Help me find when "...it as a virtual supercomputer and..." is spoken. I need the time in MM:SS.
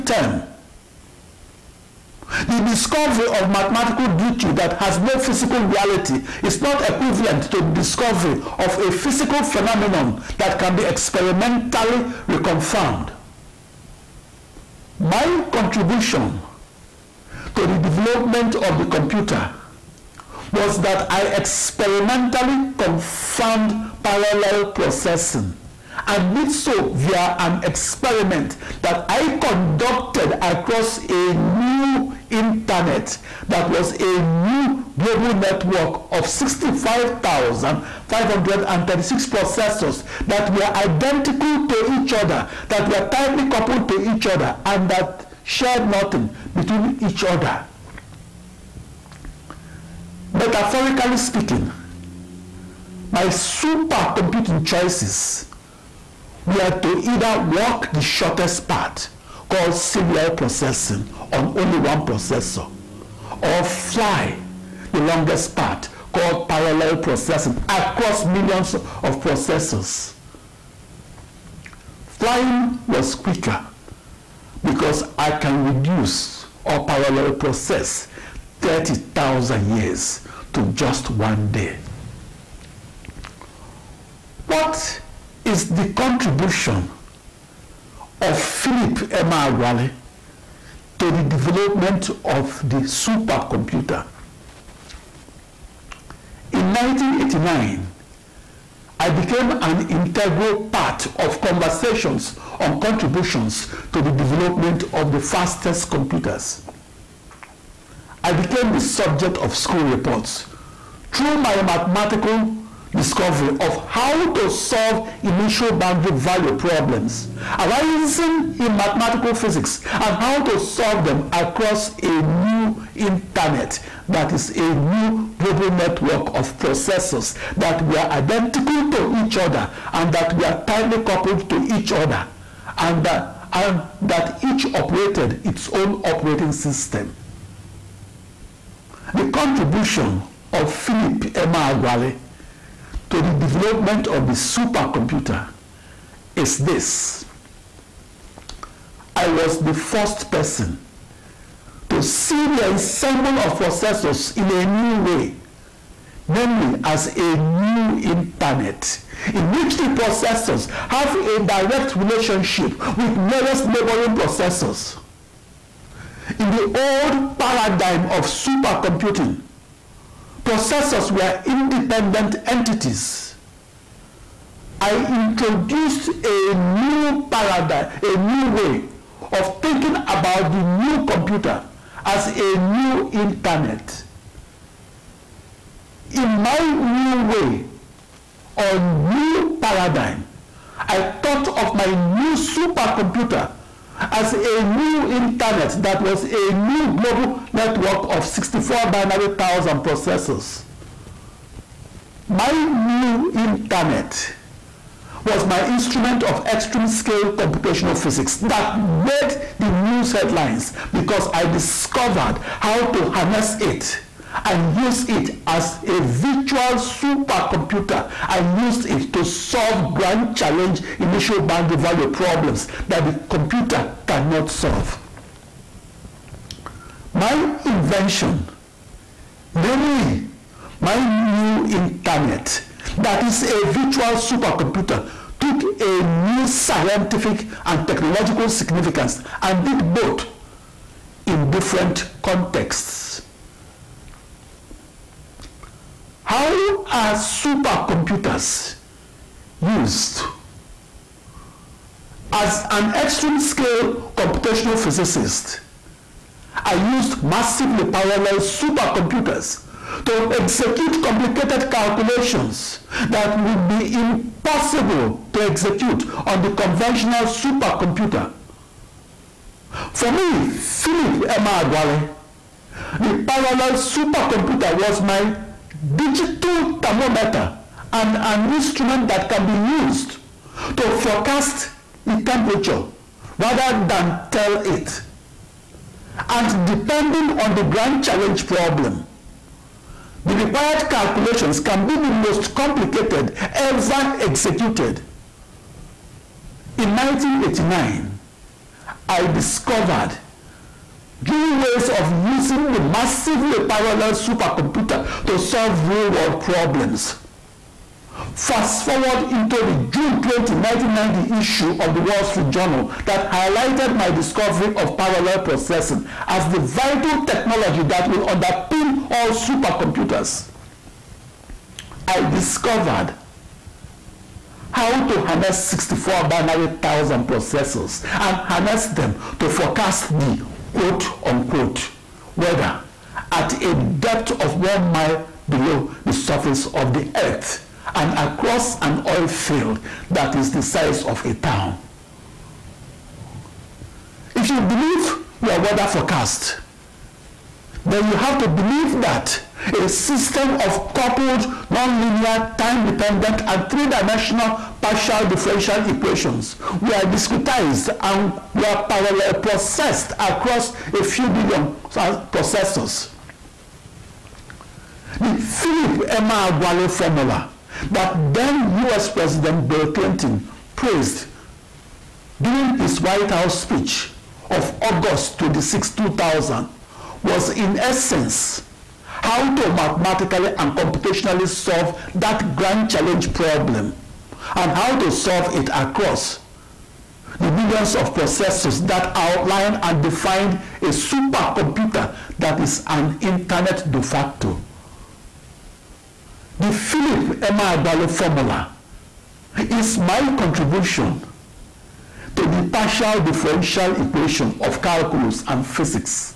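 03:35.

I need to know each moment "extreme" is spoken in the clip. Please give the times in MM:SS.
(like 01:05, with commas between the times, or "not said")
03:26, 04:12.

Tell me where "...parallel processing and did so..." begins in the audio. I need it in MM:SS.
00:24.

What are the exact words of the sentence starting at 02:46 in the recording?
In the old paradigm of supercomputing, processors were independent entities.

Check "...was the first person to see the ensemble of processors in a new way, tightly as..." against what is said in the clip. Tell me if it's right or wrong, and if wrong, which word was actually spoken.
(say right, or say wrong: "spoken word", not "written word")
wrong: "namely", not "tightly".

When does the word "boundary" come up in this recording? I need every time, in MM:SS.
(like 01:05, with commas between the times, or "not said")
01:55, 03:41.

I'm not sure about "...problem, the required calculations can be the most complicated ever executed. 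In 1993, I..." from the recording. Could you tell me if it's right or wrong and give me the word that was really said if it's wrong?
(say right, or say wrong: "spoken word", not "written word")
wrong: "1989", not "1993".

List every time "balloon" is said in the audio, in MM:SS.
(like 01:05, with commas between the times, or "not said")
not said.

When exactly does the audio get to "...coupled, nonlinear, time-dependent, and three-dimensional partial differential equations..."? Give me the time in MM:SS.
05:50.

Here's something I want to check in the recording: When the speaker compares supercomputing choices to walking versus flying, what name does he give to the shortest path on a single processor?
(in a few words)
serial processing.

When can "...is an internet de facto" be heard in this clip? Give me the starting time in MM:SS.
06:32.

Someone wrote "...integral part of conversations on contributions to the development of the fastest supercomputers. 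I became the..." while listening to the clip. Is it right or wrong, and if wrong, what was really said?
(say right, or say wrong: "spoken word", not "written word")
wrong: "computers", not "supercomputers".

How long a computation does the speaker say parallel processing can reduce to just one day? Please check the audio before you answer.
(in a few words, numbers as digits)
30,000 years.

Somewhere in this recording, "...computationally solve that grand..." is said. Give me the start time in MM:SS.
06:20.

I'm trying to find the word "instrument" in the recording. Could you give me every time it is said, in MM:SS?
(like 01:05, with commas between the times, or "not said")
03:25, 04:38.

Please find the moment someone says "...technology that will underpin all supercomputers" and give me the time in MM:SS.
05:17.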